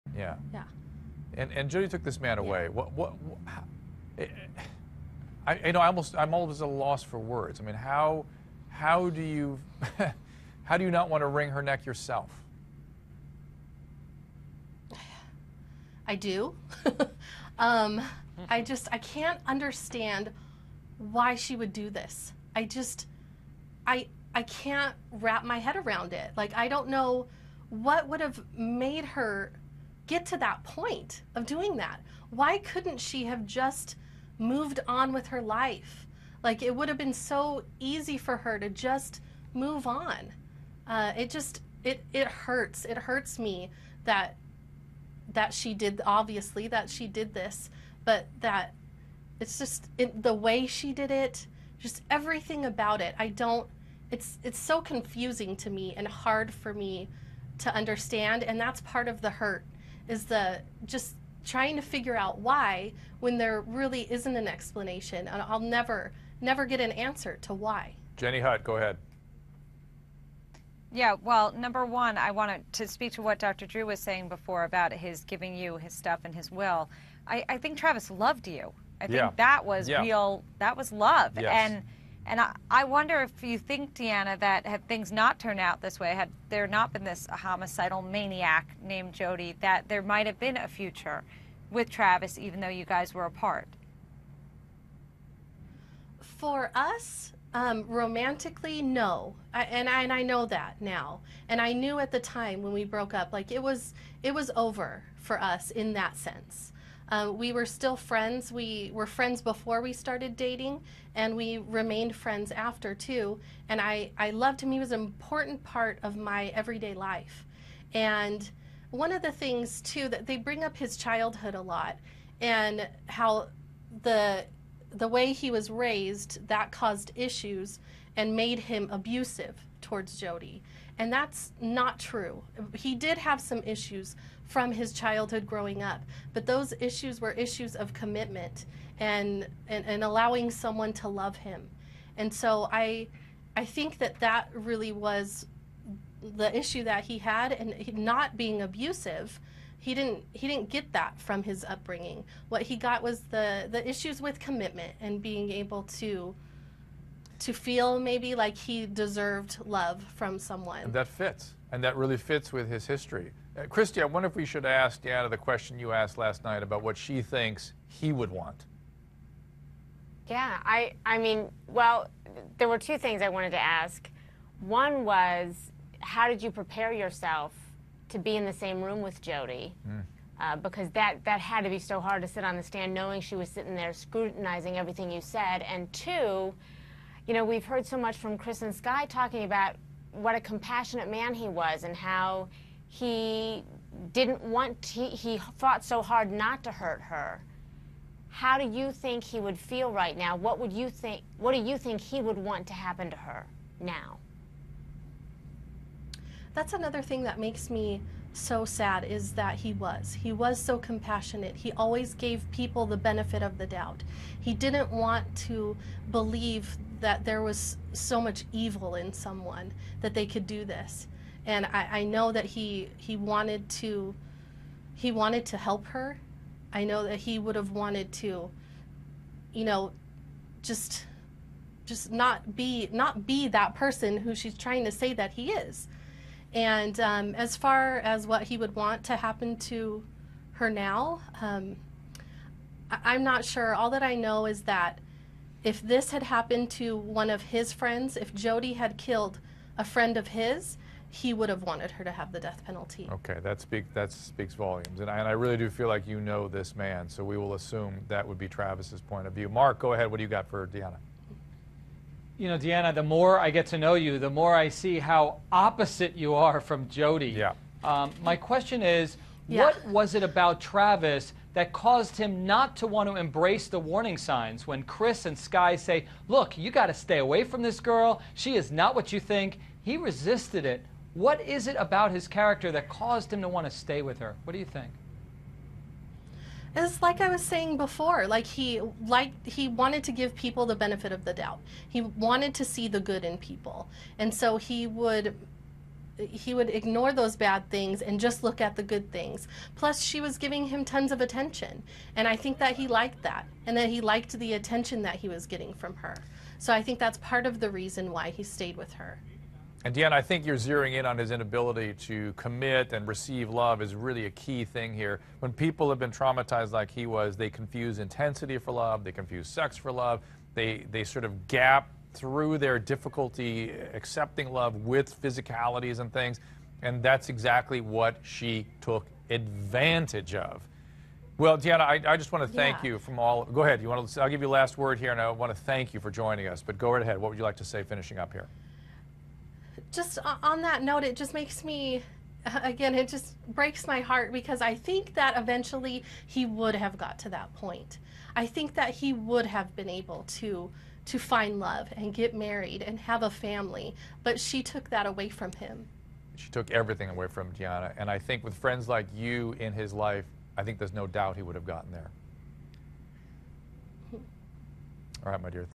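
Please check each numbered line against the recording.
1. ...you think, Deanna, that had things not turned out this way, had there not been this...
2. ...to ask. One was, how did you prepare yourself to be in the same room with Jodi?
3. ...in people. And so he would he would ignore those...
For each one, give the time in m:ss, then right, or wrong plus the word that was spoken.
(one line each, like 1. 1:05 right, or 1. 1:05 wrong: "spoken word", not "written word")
1. 1:23 right
2. 2:53 right
3. 4:53 right.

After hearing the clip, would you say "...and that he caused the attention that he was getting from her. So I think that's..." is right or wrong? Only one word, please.
wrong.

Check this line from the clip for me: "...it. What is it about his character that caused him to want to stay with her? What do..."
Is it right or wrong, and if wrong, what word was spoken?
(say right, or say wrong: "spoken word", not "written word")
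right.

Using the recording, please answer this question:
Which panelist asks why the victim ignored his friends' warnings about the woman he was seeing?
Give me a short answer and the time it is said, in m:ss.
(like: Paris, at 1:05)
Mark, at 4:19.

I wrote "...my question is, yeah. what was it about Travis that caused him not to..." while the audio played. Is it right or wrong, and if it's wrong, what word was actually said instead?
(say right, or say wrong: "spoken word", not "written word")
right.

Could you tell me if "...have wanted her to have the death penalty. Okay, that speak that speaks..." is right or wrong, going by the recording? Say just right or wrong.
right.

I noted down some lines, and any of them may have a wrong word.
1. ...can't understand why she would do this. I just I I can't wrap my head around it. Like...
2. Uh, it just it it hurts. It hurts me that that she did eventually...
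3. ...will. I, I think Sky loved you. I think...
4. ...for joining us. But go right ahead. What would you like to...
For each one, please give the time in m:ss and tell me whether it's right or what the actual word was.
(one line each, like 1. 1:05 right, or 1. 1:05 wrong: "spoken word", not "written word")
1. 0:18 right
2. 0:40 wrong: "obviously", not "eventually"
3. 1:16 wrong: "Travis", not "Sky"
4. 5:35 right.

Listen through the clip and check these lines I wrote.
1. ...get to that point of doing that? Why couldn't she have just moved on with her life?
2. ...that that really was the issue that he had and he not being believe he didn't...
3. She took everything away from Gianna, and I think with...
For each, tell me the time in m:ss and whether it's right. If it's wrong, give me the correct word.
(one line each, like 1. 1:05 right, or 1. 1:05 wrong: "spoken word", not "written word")
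1. 0:30 right
2. 2:23 wrong: "abusive", not "believe"
3. 5:56 right.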